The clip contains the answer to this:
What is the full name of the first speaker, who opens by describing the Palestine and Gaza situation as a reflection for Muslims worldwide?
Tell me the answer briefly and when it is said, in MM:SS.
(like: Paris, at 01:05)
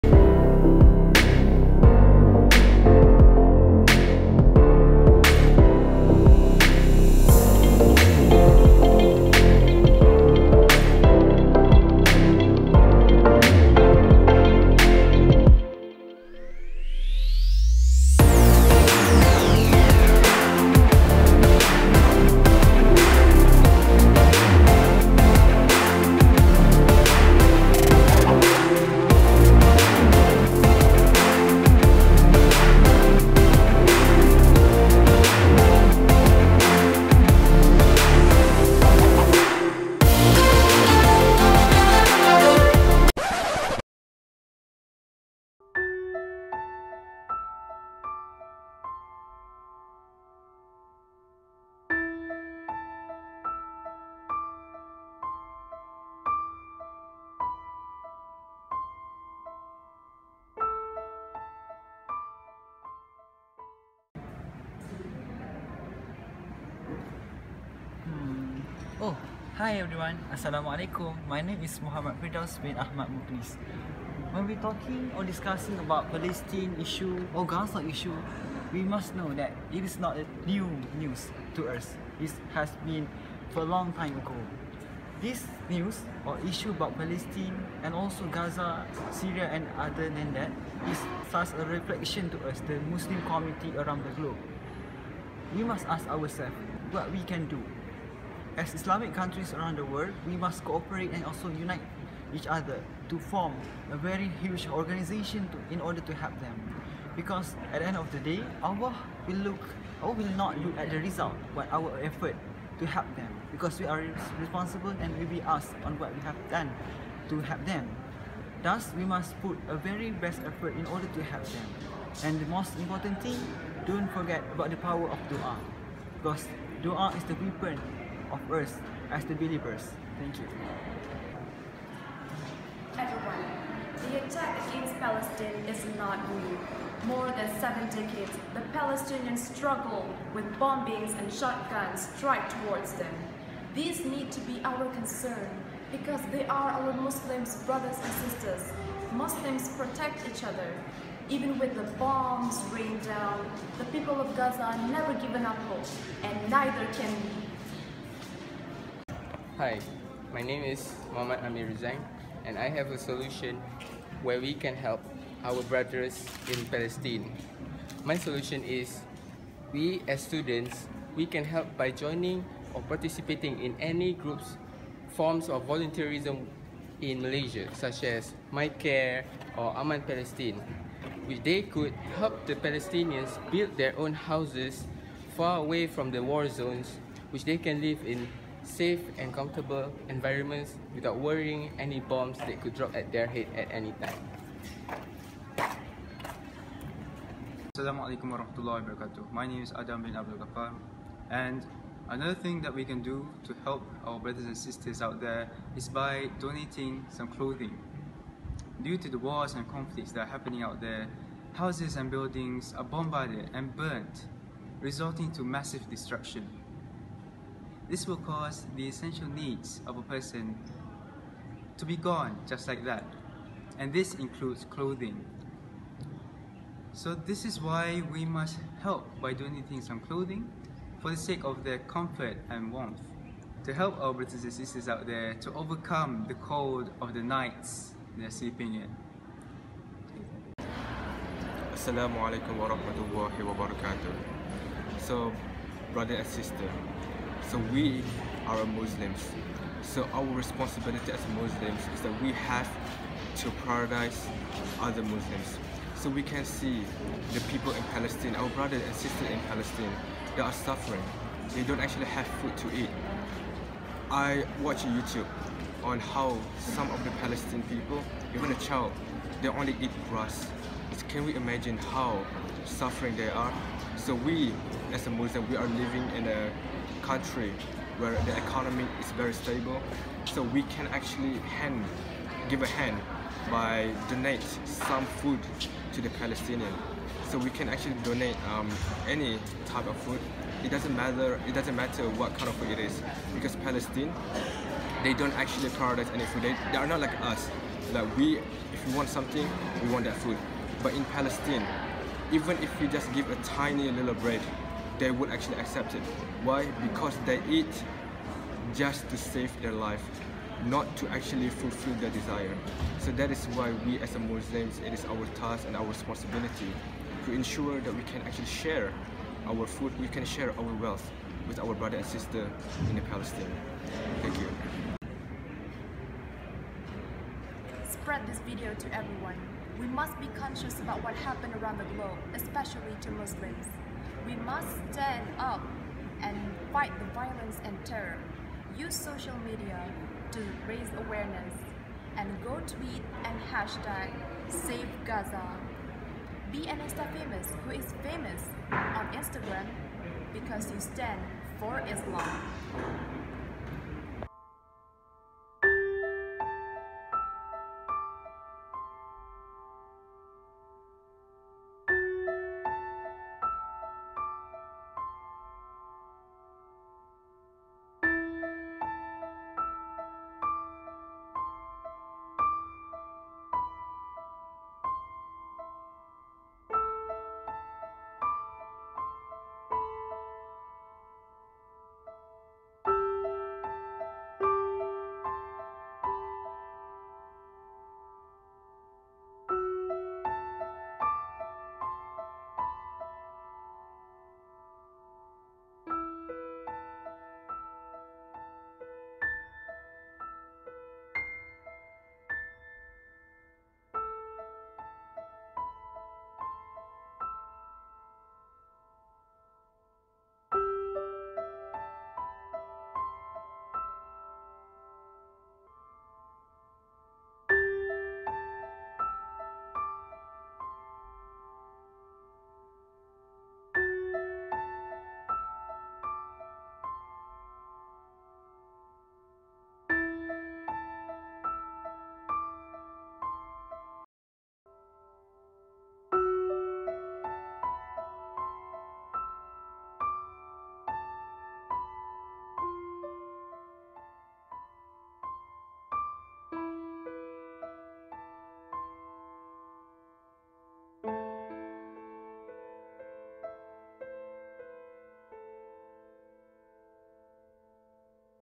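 Muhammad Firdaus bin Ahmad Mokhlis, at 01:11.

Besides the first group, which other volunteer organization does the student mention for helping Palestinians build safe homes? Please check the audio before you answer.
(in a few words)
Aman Palestine.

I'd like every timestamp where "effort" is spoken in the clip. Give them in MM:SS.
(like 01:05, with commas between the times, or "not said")
01:52, 02:00.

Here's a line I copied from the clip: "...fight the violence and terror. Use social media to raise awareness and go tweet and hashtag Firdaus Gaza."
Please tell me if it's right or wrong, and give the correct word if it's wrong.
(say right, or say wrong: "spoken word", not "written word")
wrong: "Save", not "Firdaus".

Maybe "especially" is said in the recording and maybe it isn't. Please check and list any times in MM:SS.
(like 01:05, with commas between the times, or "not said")
05:32.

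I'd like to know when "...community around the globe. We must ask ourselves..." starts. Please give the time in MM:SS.
01:33.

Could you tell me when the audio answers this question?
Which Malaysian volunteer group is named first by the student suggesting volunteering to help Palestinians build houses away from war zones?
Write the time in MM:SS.
02:58.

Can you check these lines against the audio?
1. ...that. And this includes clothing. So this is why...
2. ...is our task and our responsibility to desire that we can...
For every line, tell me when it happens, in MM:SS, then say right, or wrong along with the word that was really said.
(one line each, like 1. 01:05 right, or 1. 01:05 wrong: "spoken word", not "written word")
1. 03:42 right
2. 05:14 wrong: "ensure", not "desire".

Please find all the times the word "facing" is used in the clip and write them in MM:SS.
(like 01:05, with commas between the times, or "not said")
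not said.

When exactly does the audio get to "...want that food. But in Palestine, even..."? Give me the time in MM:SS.
04:59.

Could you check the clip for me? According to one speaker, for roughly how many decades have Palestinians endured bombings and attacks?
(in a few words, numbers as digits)
7.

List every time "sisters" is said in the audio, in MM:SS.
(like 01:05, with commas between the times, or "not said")
02:28, 03:24, 03:54, 04:06, 04:18, 05:22.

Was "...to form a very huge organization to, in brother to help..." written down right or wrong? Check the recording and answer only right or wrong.
wrong.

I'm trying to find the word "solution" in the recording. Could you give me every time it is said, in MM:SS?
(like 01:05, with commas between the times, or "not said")
02:42, 02:48.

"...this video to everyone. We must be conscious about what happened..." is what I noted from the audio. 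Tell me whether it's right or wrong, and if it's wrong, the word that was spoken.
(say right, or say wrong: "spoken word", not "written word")
right.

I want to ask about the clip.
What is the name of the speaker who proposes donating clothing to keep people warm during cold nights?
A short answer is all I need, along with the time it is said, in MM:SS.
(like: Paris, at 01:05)
Adam bin Abdul Gapar, at 03:19.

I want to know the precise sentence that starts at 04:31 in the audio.
Can we imagine how suffering they are?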